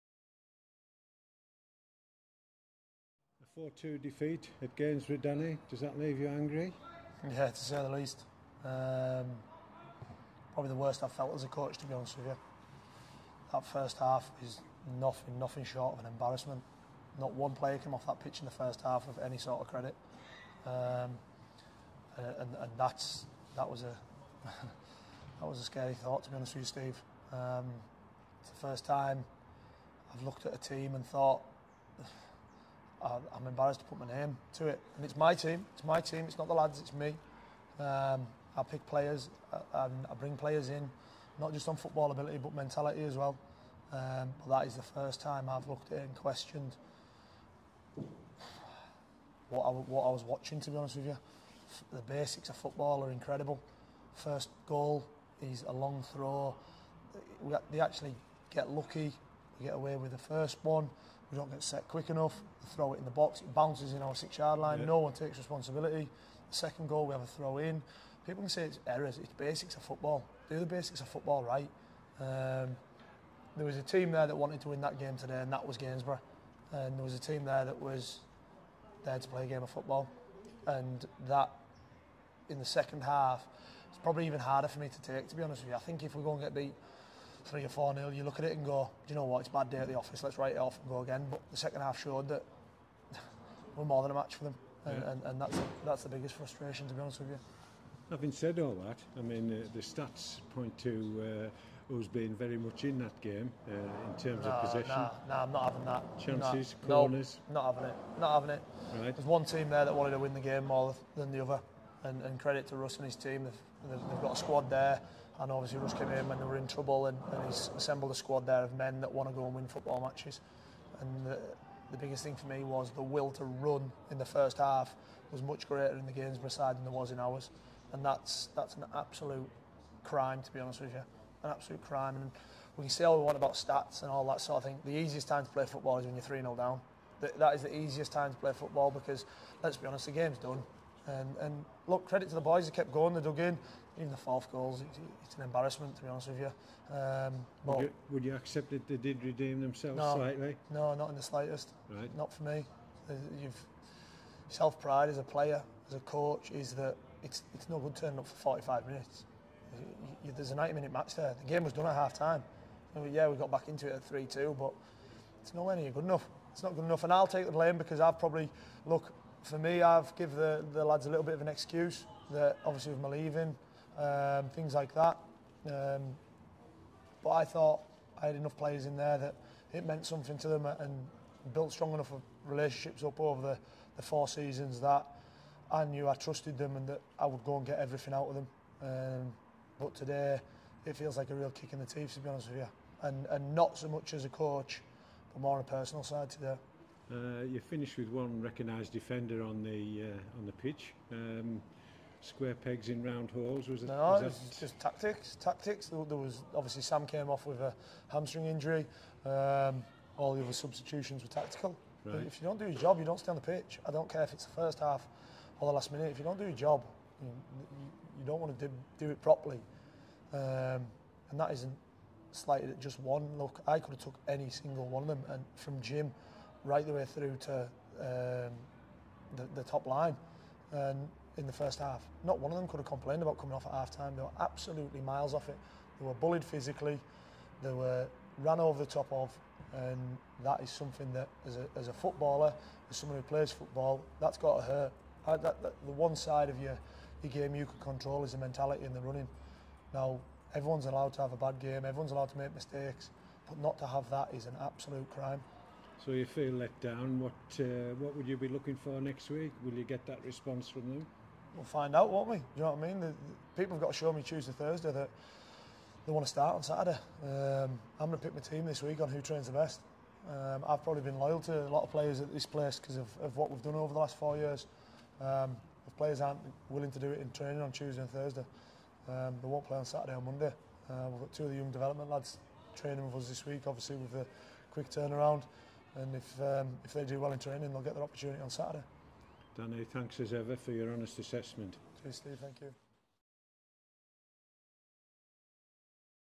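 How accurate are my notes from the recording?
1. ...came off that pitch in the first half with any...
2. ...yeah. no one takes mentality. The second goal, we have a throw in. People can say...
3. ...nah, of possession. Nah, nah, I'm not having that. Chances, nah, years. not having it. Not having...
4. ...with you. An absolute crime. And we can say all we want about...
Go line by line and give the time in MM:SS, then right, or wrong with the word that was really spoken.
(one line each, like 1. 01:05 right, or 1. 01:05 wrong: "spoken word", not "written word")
1. 00:17 right
2. 01:04 wrong: "responsibility", not "mentality"
3. 01:44 wrong: "corners", not "years"
4. 02:10 right.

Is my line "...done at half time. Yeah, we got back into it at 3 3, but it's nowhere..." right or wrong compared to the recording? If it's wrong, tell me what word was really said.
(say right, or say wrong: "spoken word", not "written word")
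wrong: "2", not "3".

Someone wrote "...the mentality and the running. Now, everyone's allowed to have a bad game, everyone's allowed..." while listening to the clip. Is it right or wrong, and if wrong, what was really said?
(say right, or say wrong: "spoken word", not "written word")
right.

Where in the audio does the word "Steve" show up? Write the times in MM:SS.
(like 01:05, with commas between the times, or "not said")
00:26, 04:52.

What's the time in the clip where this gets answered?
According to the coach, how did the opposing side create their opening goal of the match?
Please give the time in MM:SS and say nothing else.
00:55.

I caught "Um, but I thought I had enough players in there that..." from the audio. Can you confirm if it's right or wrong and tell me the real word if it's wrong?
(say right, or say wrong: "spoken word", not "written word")
right.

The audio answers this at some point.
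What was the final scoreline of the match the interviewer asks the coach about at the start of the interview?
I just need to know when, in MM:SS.
00:03.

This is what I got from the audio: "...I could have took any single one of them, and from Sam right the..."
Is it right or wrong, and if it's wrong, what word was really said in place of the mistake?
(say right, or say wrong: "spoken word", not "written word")
wrong: "Jim", not "Sam".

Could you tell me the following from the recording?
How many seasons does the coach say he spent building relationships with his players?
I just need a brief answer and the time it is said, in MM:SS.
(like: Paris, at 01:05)
4, at 03:04.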